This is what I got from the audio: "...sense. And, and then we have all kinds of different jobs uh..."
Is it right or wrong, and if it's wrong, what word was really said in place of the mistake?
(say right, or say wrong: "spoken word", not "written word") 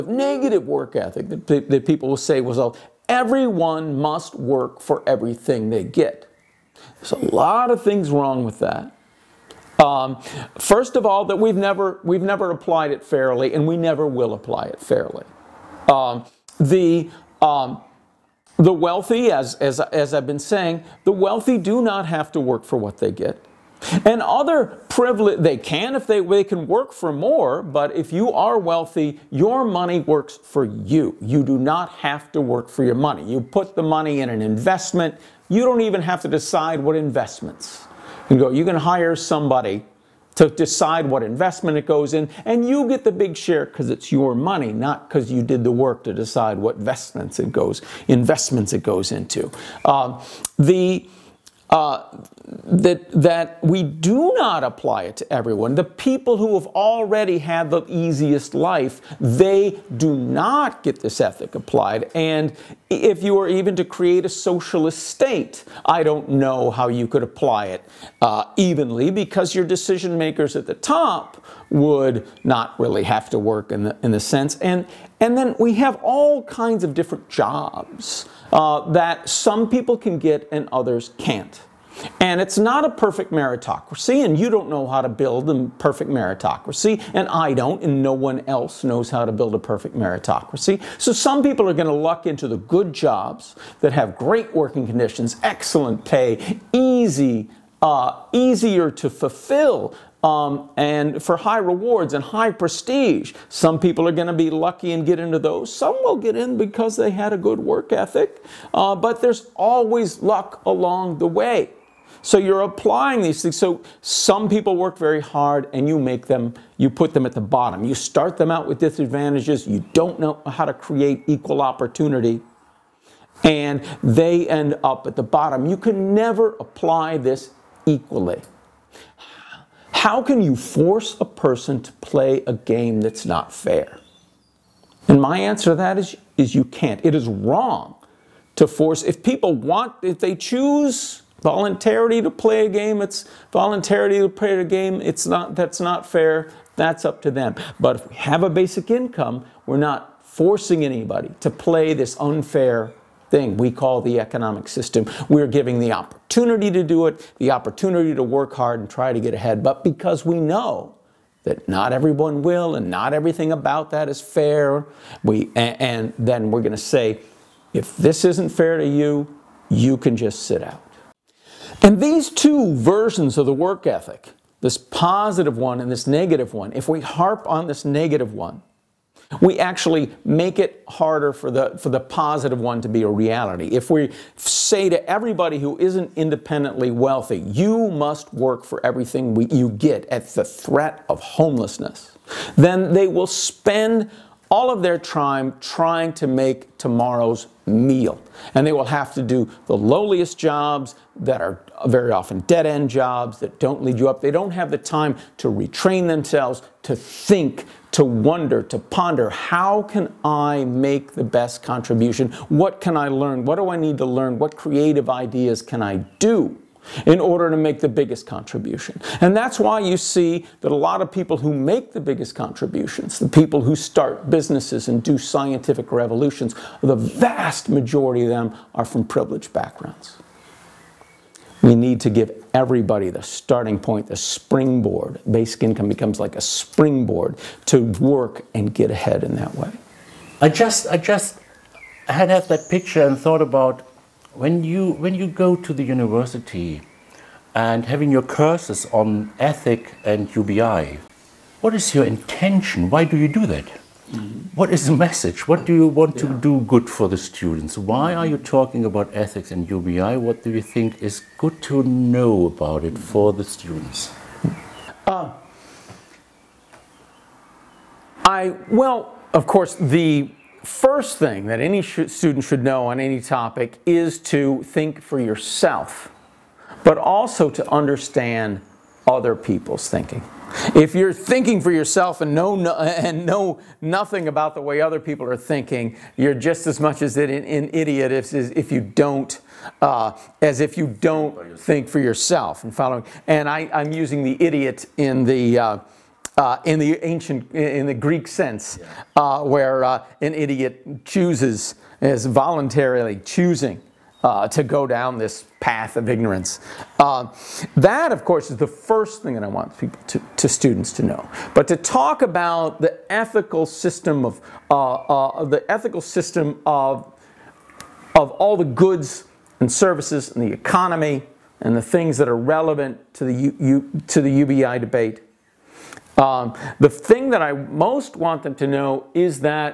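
right.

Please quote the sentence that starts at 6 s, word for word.
There's a lot of things wrong with that.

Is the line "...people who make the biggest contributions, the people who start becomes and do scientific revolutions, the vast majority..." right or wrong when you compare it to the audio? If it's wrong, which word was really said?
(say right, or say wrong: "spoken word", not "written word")
wrong: "businesses", not "becomes".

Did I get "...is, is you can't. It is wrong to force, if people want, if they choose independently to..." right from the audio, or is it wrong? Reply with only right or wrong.
wrong.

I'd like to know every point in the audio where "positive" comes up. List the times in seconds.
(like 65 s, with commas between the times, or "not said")
174 s, 181 s.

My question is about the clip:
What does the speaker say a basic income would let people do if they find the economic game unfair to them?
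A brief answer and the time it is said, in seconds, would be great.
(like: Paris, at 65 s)
sit out, at 170 s.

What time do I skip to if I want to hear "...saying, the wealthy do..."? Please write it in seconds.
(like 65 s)
20 s.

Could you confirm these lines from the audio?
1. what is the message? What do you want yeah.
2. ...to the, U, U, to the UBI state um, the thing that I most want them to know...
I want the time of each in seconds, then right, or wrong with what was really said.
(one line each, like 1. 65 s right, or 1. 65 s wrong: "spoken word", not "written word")
1. 254 s right
2. 323 s wrong: "debate", not "state".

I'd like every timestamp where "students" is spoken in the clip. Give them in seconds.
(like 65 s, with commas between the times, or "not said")
257 s, 263 s, 272 s, 310 s.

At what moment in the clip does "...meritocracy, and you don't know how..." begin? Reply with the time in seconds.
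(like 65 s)
83 s.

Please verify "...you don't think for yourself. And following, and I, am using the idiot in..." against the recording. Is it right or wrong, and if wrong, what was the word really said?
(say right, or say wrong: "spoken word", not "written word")
right.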